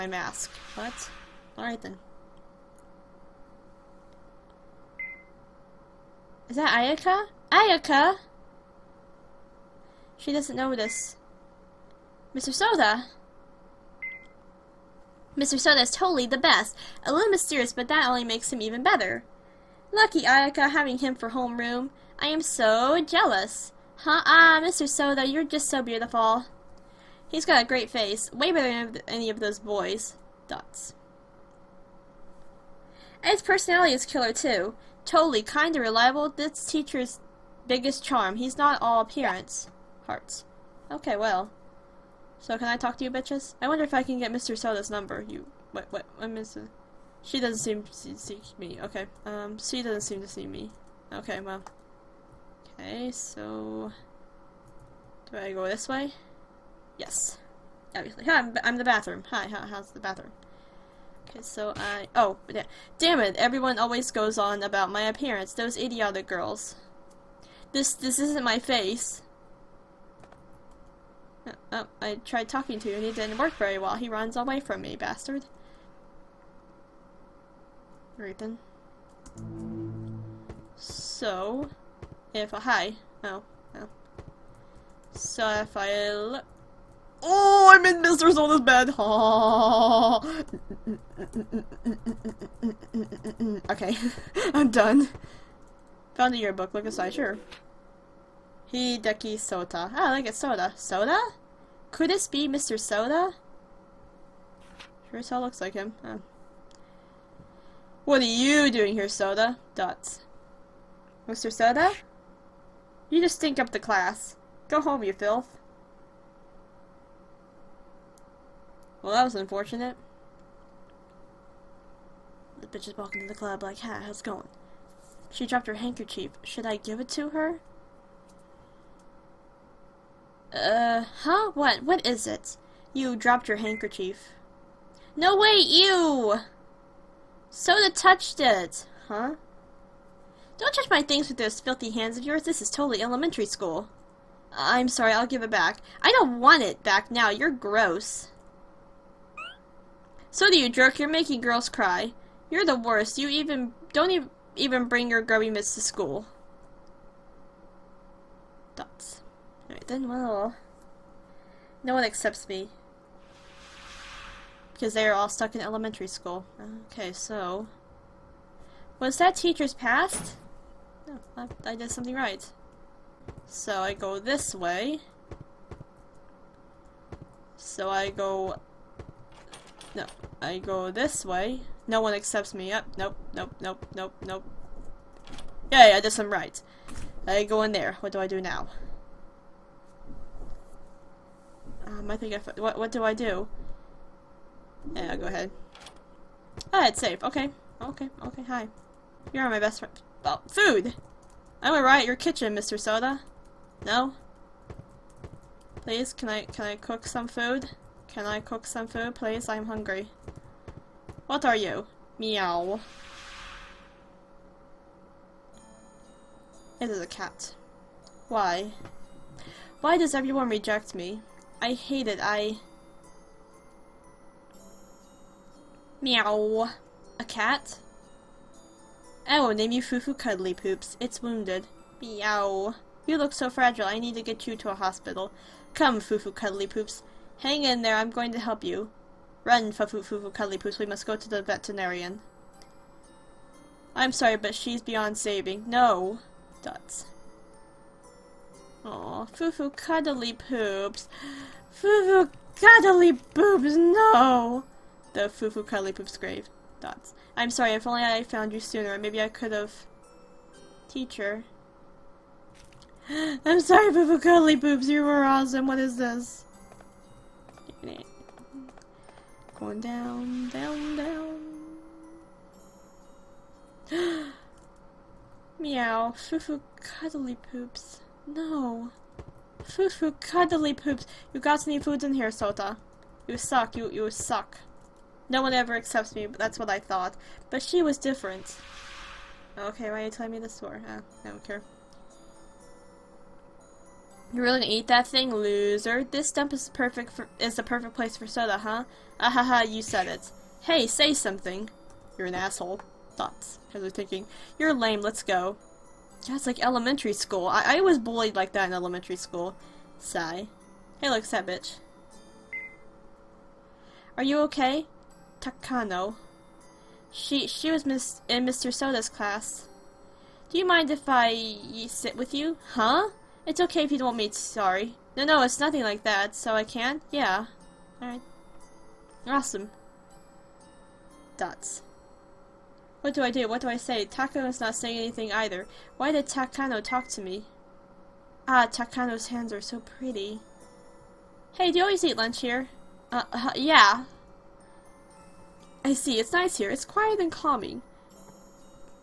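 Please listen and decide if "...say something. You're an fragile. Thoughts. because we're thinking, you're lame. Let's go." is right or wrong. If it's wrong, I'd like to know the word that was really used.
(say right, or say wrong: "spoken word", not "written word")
wrong: "asshole", not "fragile".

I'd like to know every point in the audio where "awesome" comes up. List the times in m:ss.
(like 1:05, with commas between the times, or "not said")
4:25, 5:29.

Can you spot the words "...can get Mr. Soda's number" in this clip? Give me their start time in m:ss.
0:44.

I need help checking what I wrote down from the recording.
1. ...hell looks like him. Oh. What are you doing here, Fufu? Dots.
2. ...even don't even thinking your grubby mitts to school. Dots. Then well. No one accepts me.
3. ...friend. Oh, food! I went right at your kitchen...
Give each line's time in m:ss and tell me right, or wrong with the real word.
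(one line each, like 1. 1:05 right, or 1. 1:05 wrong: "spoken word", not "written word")
1. 1:45 wrong: "Soda", not "Fufu"
2. 2:33 wrong: "bring", not "thinking"
3. 3:19 right.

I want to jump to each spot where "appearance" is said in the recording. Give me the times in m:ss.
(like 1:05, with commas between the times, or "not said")
0:39, 1:05.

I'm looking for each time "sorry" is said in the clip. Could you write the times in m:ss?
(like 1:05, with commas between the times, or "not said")
2:24, 4:04, 4:17, 4:23, 5:24.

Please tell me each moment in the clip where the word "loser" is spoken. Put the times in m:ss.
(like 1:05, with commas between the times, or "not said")
4:55.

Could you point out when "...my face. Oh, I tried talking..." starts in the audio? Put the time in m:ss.
1:08.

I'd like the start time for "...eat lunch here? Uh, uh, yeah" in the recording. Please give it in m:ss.
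5:42.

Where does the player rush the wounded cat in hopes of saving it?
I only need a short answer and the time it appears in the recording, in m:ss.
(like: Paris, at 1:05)
the veterinarian, at 4:01.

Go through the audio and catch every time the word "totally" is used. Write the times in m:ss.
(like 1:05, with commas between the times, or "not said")
0:15, 0:35, 2:22.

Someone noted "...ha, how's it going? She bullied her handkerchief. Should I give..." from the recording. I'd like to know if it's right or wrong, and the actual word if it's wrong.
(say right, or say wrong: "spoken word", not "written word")
wrong: "dropped", not "bullied".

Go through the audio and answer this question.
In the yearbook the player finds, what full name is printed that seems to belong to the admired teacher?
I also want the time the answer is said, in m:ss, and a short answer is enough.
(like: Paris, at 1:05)
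Hideki Sota, at 1:38.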